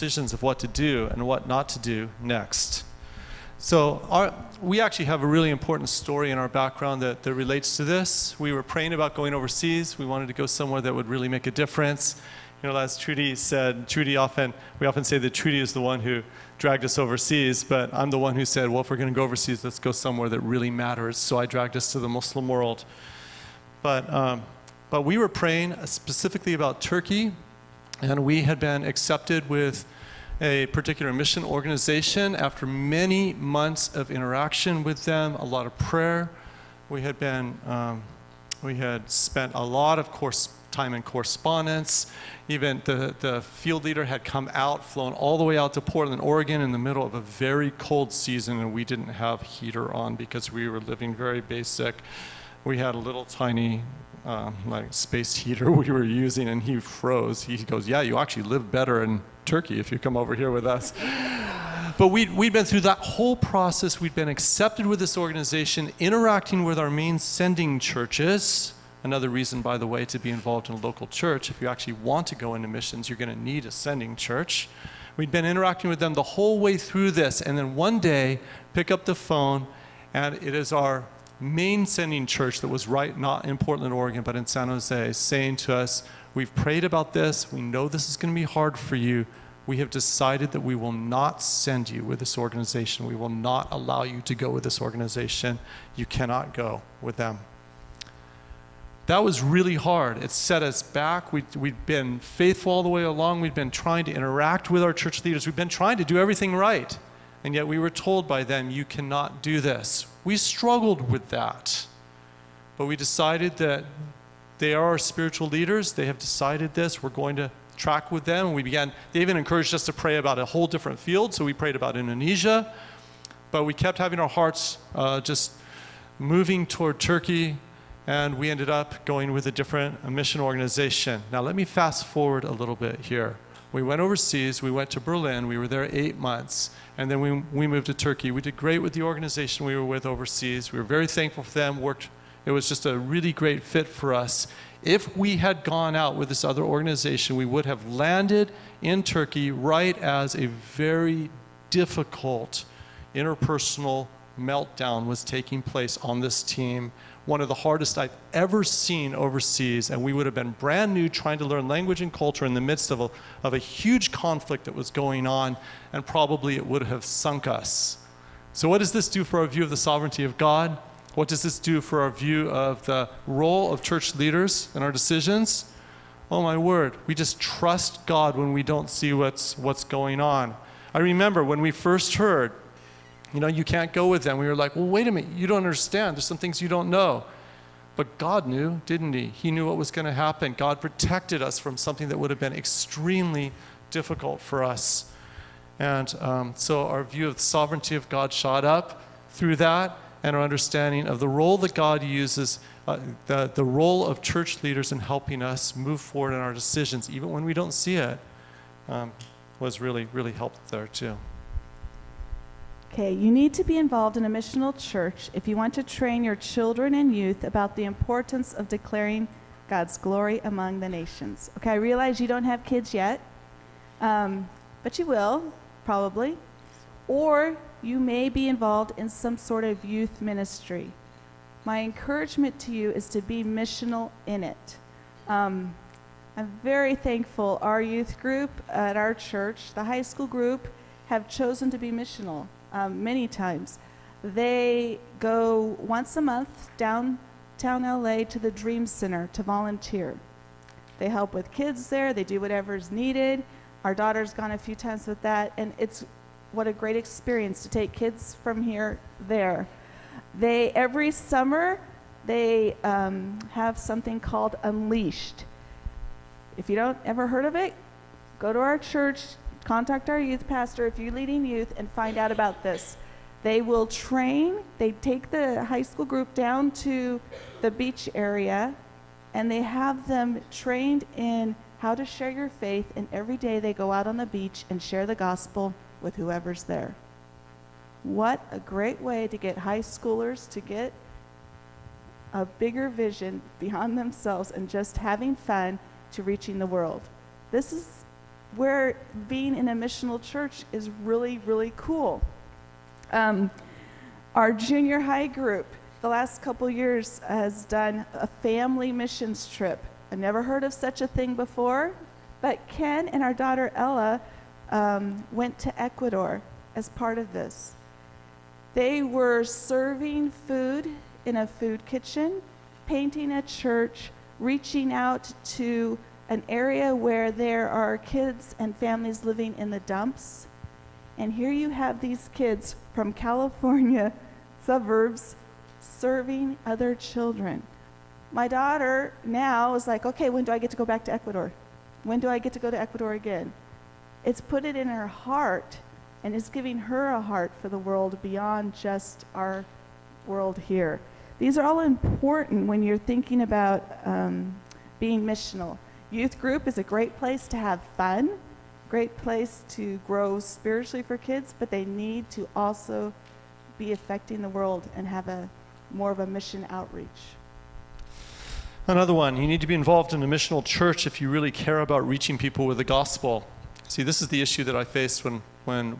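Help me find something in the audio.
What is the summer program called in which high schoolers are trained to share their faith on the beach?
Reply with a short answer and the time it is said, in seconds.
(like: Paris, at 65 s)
Unleashed, at 264 s.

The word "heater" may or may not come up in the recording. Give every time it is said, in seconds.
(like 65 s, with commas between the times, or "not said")
49 s, 55 s.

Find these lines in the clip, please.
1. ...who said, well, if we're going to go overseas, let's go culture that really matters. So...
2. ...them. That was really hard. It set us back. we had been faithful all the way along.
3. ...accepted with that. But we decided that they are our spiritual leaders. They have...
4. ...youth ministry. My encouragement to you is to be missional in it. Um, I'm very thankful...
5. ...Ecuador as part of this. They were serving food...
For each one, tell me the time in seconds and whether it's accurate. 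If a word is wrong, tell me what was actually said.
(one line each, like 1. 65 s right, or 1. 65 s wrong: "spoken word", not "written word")
1. 18 s wrong: "somewhere", not "culture"
2. 97 s right
3. 110 s wrong: "struggled", not "accepted"
4. 229 s right
5. 315 s right.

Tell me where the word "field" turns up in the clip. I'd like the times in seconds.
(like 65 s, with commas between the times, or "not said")
43 s, 120 s.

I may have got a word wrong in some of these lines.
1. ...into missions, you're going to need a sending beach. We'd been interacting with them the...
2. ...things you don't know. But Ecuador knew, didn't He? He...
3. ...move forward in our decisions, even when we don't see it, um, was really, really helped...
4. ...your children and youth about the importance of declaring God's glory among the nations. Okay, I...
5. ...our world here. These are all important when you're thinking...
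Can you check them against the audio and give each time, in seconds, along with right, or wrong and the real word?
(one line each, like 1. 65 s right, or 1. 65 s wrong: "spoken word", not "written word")
1. 72 s wrong: "church", not "beach"
2. 186 s wrong: "God", not "Ecuador"
3. 205 s right
4. 216 s right
5. 349 s right.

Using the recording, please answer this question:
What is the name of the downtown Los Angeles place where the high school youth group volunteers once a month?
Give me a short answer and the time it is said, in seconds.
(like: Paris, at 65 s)
Dream Center, at 248 s.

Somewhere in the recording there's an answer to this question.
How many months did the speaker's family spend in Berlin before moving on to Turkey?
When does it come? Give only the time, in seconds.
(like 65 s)
135 s.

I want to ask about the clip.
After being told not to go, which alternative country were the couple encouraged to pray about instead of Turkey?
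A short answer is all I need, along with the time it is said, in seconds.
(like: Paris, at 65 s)
Indonesia, at 121 s.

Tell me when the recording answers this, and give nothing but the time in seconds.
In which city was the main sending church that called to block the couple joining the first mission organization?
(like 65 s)
84 s.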